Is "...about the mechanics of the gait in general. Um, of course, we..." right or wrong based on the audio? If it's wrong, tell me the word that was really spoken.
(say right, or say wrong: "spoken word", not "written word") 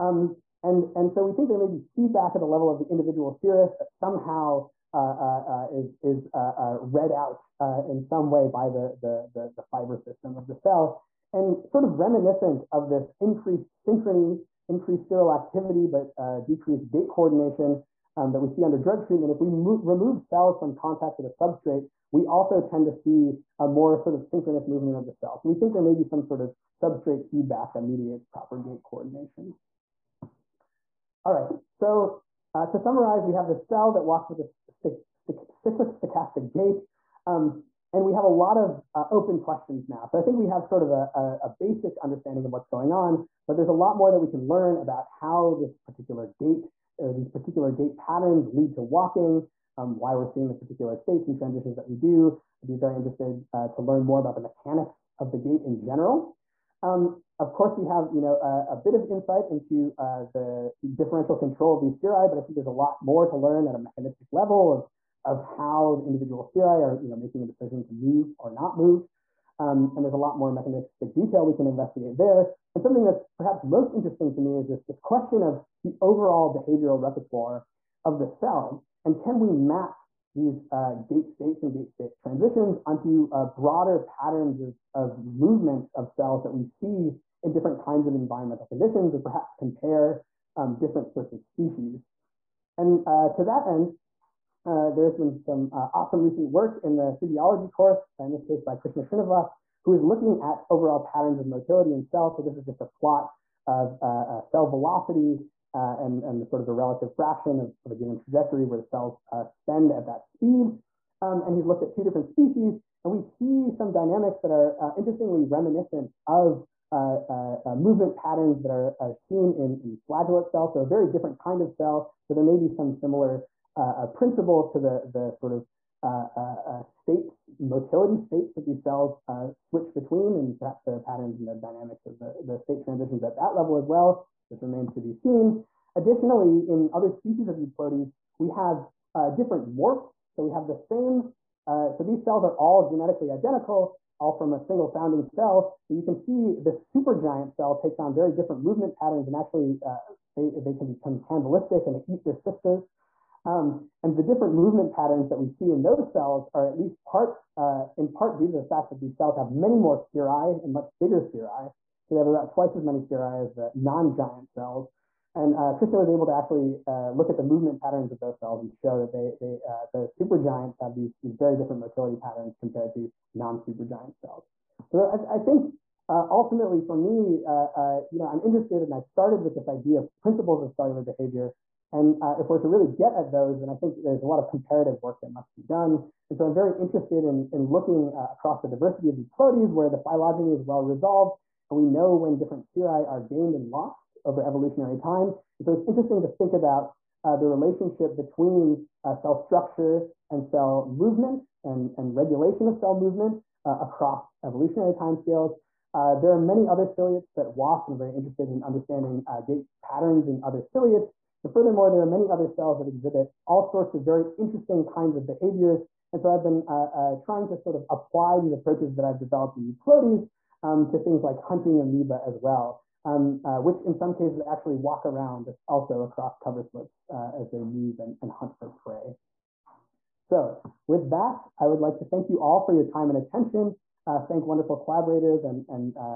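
right.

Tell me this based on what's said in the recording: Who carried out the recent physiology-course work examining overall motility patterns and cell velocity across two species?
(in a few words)
Krishna Srinivas.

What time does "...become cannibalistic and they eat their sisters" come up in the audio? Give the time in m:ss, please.
2:30.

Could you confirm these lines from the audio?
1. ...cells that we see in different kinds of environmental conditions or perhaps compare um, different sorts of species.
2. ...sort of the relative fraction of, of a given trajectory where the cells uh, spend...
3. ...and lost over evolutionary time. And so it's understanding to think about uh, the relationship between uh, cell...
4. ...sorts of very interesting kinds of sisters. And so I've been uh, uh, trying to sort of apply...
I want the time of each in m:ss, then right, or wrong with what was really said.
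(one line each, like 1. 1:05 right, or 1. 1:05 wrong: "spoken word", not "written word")
1. 1:26 right
2. 1:46 right
3. 3:13 wrong: "interesting", not "understanding"
4. 3:33 wrong: "behaviors", not "sisters".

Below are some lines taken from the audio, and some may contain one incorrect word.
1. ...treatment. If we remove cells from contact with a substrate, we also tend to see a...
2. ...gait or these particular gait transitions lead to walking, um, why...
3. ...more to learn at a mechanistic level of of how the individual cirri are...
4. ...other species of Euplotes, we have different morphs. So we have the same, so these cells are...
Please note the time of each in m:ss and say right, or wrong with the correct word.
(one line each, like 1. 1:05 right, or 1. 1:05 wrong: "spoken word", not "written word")
1. 0:19 right
2. 0:46 wrong: "patterns", not "transitions"
3. 1:03 right
4. 2:16 right.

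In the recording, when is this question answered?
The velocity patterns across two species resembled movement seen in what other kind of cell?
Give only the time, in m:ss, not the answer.
2:00.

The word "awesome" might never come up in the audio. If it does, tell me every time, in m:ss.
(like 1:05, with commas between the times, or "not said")
1:35.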